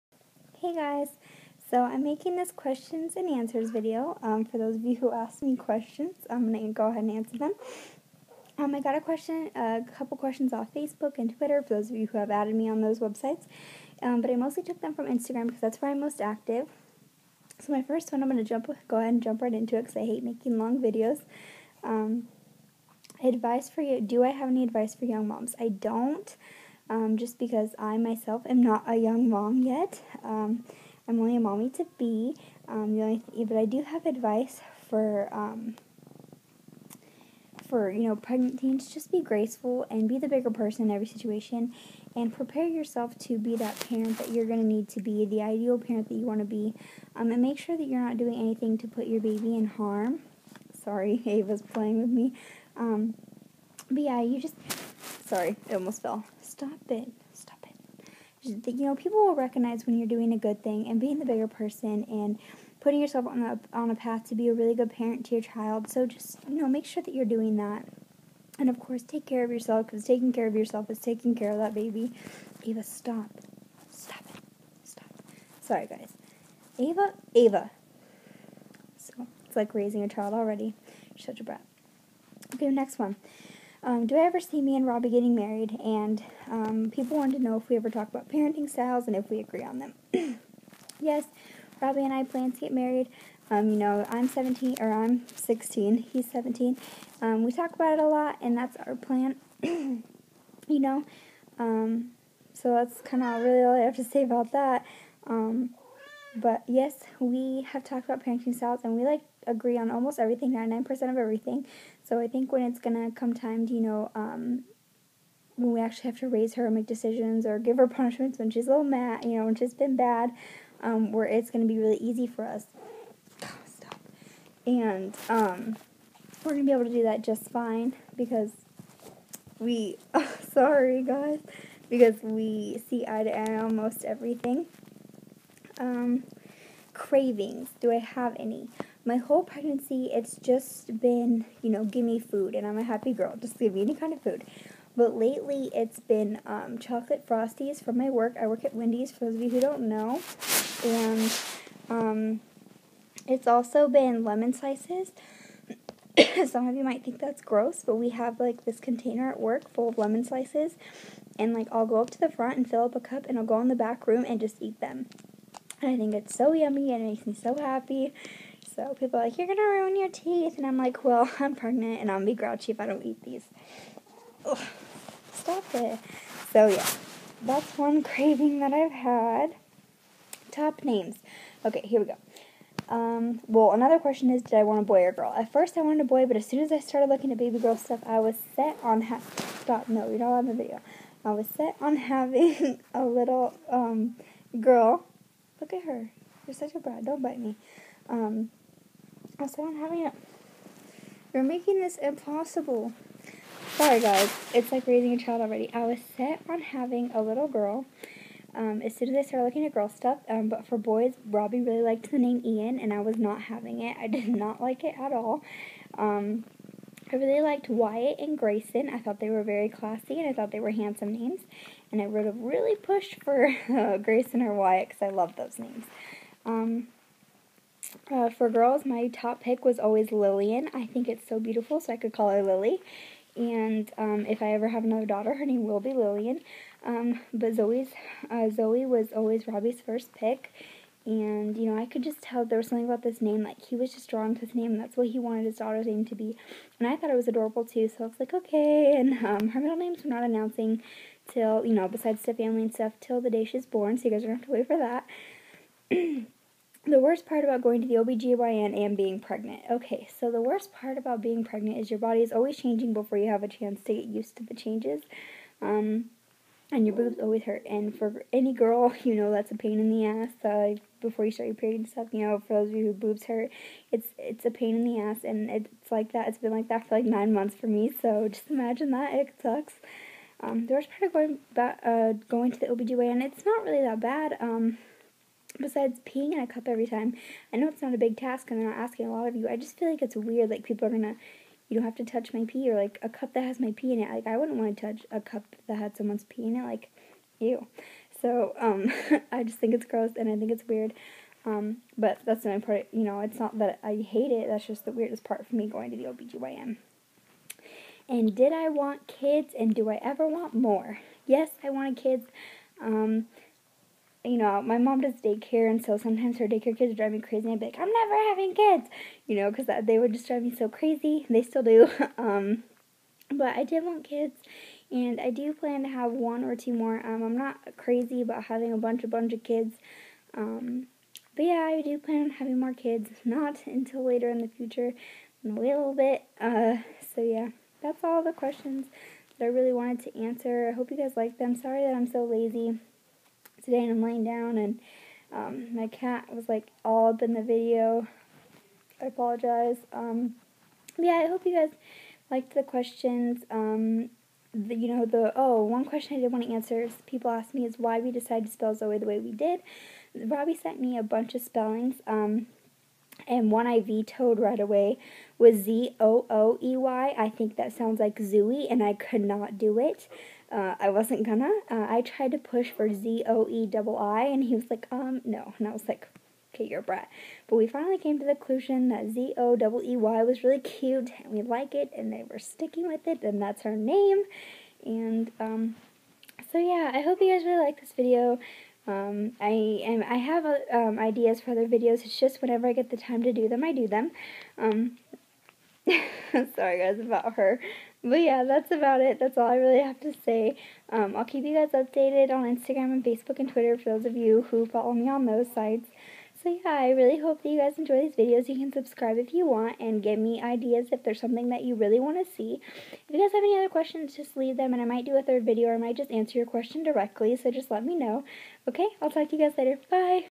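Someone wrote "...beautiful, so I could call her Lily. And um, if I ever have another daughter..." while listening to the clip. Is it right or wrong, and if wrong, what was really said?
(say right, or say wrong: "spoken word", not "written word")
right.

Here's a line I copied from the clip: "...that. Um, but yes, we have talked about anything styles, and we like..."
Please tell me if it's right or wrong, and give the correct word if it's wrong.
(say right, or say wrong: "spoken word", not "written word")
wrong: "parenting", not "anything".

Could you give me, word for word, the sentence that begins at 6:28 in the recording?
Um, I am I have uh, um, ideas for other videos.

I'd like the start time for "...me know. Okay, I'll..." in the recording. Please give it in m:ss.
6:57.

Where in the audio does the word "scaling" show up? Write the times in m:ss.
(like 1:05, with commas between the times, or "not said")
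not said.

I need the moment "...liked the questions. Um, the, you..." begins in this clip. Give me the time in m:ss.
5:52.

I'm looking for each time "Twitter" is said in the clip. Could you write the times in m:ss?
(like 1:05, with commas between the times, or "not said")
0:11, 6:43.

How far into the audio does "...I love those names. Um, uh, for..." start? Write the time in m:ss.
3:45.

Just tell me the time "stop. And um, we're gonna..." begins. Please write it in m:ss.
2:03.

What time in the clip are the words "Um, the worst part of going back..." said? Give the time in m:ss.
4:40.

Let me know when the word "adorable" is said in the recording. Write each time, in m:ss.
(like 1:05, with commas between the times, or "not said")
4:07.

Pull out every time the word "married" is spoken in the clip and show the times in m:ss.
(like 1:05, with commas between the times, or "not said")
1:25, 1:32.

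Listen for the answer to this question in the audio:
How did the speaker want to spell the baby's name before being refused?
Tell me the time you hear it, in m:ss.
6:12.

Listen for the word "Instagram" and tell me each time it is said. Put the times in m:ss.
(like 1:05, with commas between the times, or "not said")
0:15, 6:42.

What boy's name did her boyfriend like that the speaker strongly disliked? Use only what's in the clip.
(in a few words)
Ian.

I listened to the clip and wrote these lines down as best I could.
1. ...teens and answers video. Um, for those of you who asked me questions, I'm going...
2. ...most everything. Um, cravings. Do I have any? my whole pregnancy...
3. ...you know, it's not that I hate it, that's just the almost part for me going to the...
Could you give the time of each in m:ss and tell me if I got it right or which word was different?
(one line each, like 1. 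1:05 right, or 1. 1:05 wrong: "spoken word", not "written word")
1. 0:02 wrong: "questions", not "teens"
2. 2:13 right
3. 5:02 wrong: "weirdest", not "almost".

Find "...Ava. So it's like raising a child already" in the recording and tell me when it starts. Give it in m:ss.
1:17.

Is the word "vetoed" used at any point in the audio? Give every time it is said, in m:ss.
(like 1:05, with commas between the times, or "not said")
6:03.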